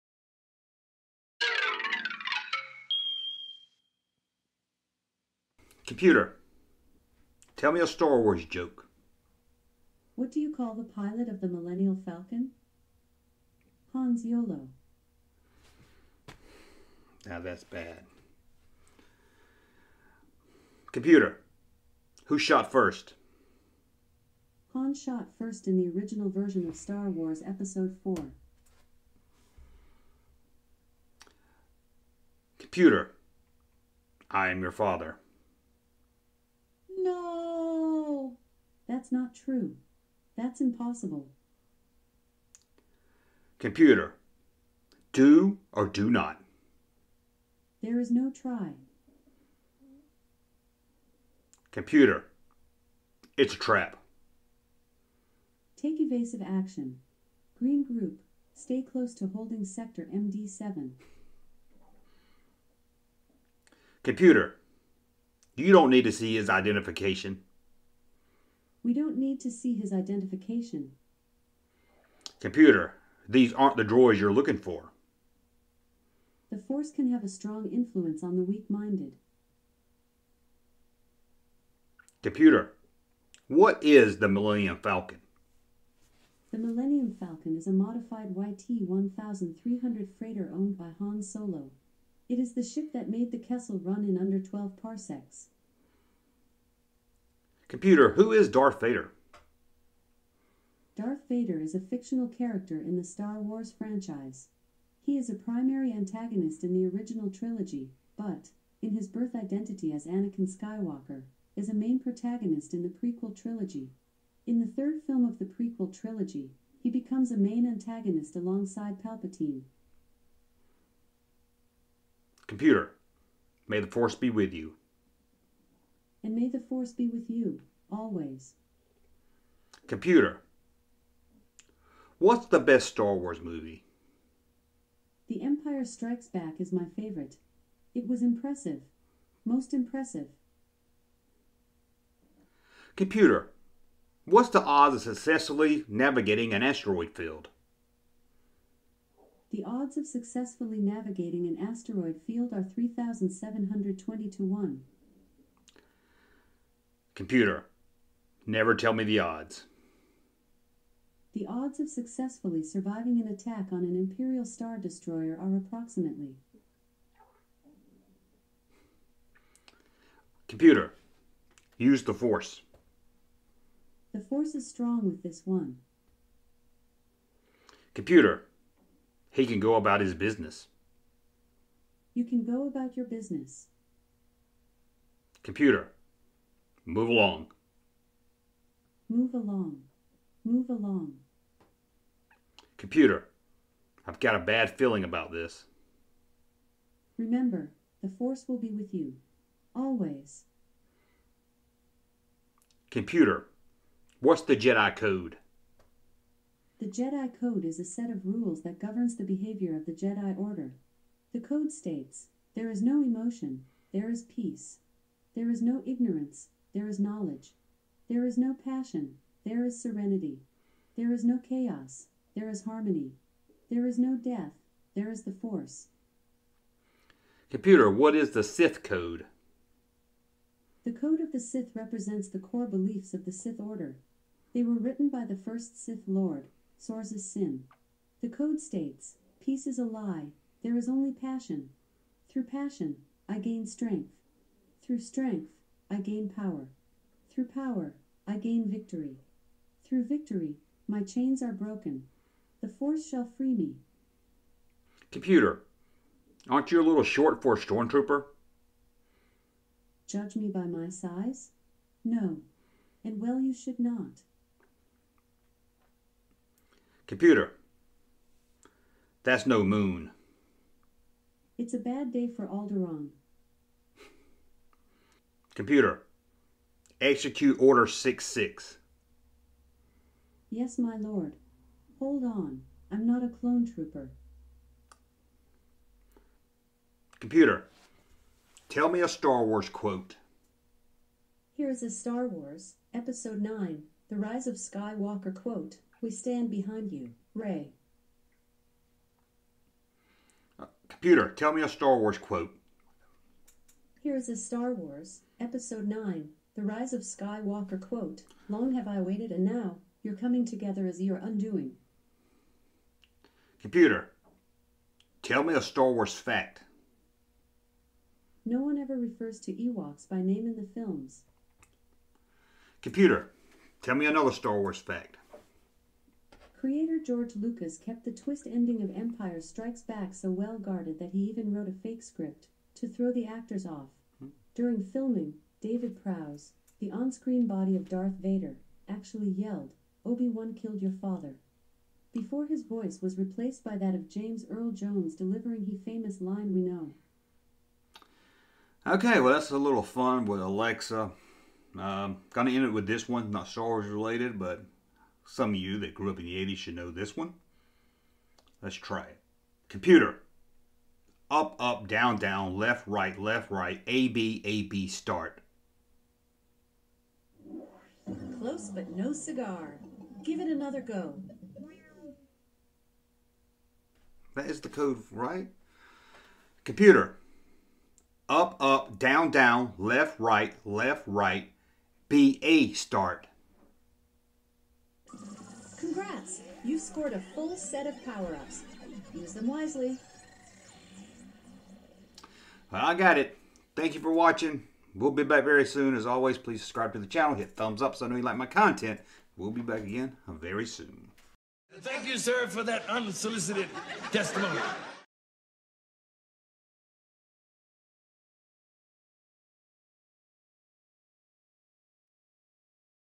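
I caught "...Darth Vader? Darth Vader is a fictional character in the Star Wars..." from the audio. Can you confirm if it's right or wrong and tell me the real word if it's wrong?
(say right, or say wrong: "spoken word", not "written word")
right.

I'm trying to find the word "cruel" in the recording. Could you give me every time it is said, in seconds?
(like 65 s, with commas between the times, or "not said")
not said.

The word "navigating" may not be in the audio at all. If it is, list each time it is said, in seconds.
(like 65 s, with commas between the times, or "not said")
145 s, 150 s.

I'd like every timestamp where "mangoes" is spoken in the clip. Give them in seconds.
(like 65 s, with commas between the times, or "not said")
not said.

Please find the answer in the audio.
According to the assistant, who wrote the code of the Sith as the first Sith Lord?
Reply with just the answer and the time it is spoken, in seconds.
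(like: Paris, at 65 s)
Sorzus Syn, at 236 s.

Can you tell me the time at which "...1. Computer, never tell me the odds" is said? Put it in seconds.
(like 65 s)
154 s.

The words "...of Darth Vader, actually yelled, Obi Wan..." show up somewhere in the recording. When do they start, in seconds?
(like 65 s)
337 s.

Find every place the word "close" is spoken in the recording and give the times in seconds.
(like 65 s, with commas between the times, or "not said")
58 s, 368 s.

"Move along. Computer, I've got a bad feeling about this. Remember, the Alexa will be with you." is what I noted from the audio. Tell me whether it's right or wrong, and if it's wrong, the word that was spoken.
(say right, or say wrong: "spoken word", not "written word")
wrong: "Force", not "Alexa".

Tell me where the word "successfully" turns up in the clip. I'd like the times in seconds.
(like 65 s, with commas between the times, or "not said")
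145 s, 150 s, 161 s.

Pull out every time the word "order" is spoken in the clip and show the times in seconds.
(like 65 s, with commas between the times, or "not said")
210 s, 233 s, 277 s.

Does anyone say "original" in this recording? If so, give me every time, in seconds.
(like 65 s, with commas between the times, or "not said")
25 s, 106 s.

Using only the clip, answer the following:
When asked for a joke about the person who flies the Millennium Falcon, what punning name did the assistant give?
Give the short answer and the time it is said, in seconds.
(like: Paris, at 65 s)
Hans Yolo, at 13 s.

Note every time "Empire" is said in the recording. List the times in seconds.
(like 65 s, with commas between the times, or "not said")
135 s, 328 s.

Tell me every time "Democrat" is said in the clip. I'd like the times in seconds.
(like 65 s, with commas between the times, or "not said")
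not said.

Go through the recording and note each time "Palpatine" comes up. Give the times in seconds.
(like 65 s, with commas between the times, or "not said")
119 s.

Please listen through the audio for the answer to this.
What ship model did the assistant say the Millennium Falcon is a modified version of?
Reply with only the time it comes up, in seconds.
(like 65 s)
88 s.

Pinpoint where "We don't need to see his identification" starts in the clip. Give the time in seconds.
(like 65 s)
68 s.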